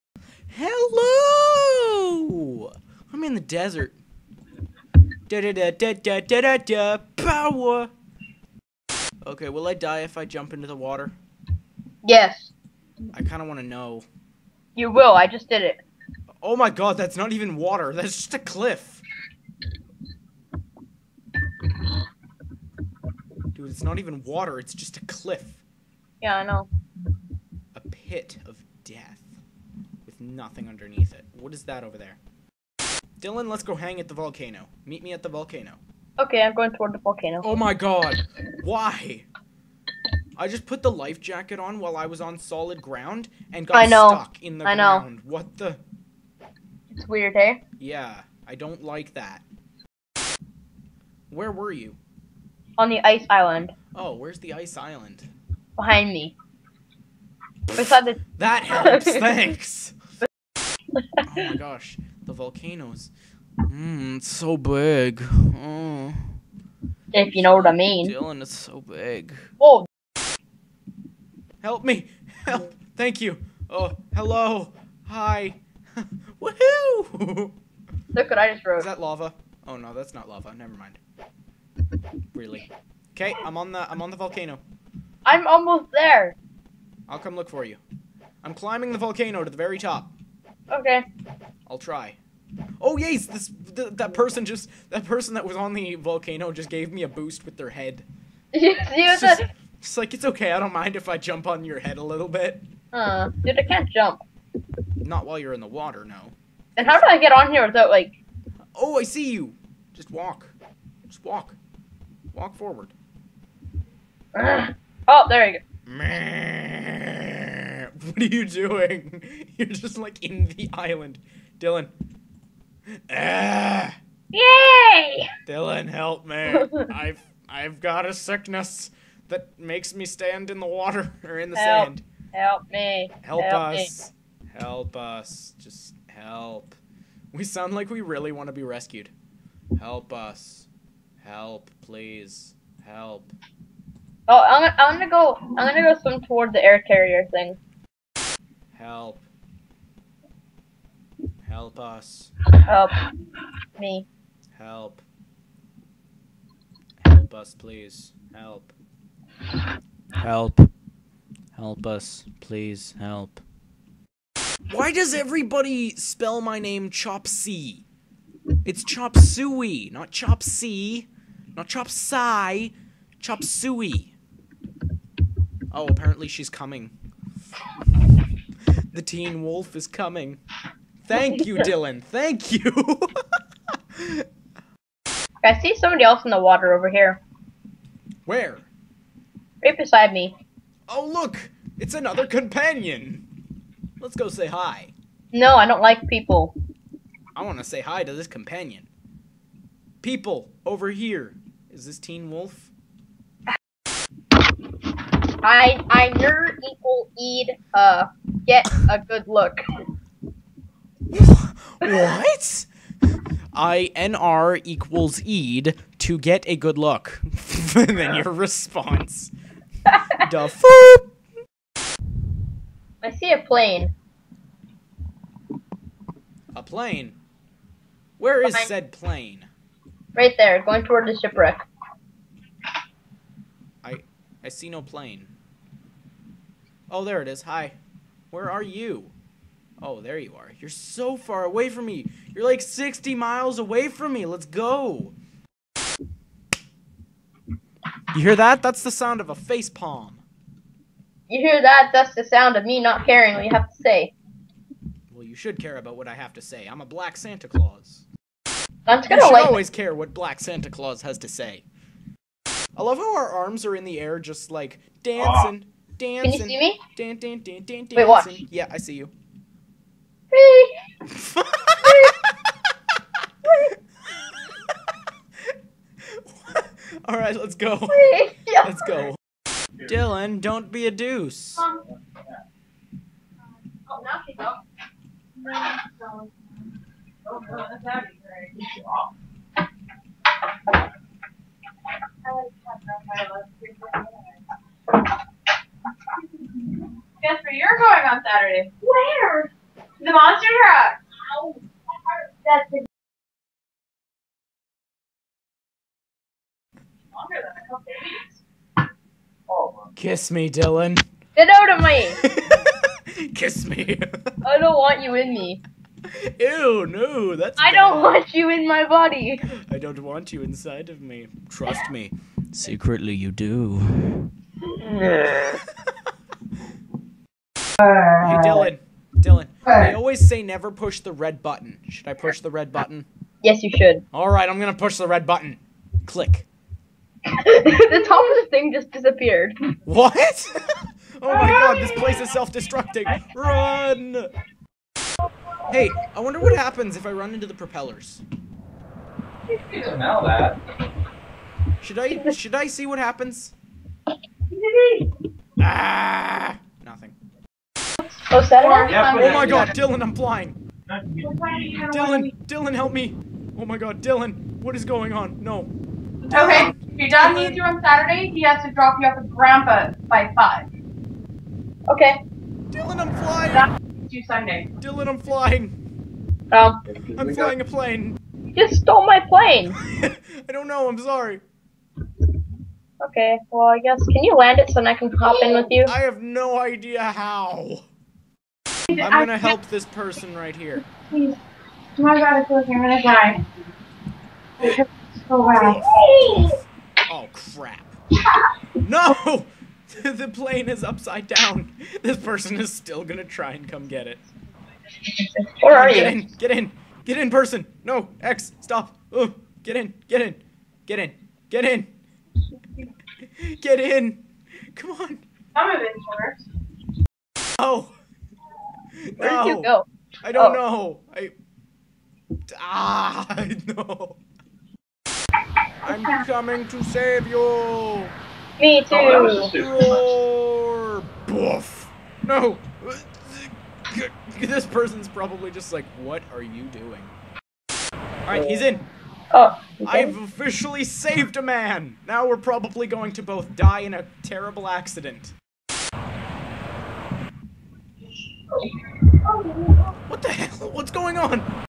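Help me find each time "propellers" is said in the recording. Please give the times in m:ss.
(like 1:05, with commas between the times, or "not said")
5:47.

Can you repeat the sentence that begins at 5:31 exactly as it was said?
Should I push the red button?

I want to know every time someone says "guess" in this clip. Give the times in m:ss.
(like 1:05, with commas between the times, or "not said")
4:57, 6:23.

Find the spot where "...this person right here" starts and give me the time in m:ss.
6:29.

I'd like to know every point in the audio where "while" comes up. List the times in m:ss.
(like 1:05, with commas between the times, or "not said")
0:41, 1:45.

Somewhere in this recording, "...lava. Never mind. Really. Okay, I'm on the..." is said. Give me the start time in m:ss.
1:20.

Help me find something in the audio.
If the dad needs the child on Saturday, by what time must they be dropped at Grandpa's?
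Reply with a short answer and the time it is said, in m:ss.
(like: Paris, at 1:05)
5, at 6:10.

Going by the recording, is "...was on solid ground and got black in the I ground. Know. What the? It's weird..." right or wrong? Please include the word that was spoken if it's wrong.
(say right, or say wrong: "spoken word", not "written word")
wrong: "stuck", not "black".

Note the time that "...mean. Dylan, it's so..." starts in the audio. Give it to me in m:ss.
1:07.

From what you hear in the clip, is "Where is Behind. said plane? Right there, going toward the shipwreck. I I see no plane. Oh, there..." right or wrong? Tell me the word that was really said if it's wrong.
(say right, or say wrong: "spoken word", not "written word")
right.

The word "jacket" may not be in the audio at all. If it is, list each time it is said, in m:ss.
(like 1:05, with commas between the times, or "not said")
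0:41.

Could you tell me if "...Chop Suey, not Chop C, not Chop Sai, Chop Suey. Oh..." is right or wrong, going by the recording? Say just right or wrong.
right.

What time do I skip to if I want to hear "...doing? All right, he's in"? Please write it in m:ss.
7:16.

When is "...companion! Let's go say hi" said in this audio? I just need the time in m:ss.
3:12.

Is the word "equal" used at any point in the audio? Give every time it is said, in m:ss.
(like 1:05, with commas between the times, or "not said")
3:26, 3:34.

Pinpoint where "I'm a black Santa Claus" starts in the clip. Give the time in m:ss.
4:16.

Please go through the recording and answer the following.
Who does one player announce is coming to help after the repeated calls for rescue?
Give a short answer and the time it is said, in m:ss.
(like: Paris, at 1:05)
The teen wolf, at 2:58.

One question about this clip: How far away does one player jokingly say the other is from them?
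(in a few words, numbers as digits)
60 miles.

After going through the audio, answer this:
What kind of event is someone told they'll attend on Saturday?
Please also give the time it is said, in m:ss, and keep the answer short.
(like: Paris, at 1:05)
Monster truck, at 5:00.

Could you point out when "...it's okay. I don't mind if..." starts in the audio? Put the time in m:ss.
1:40.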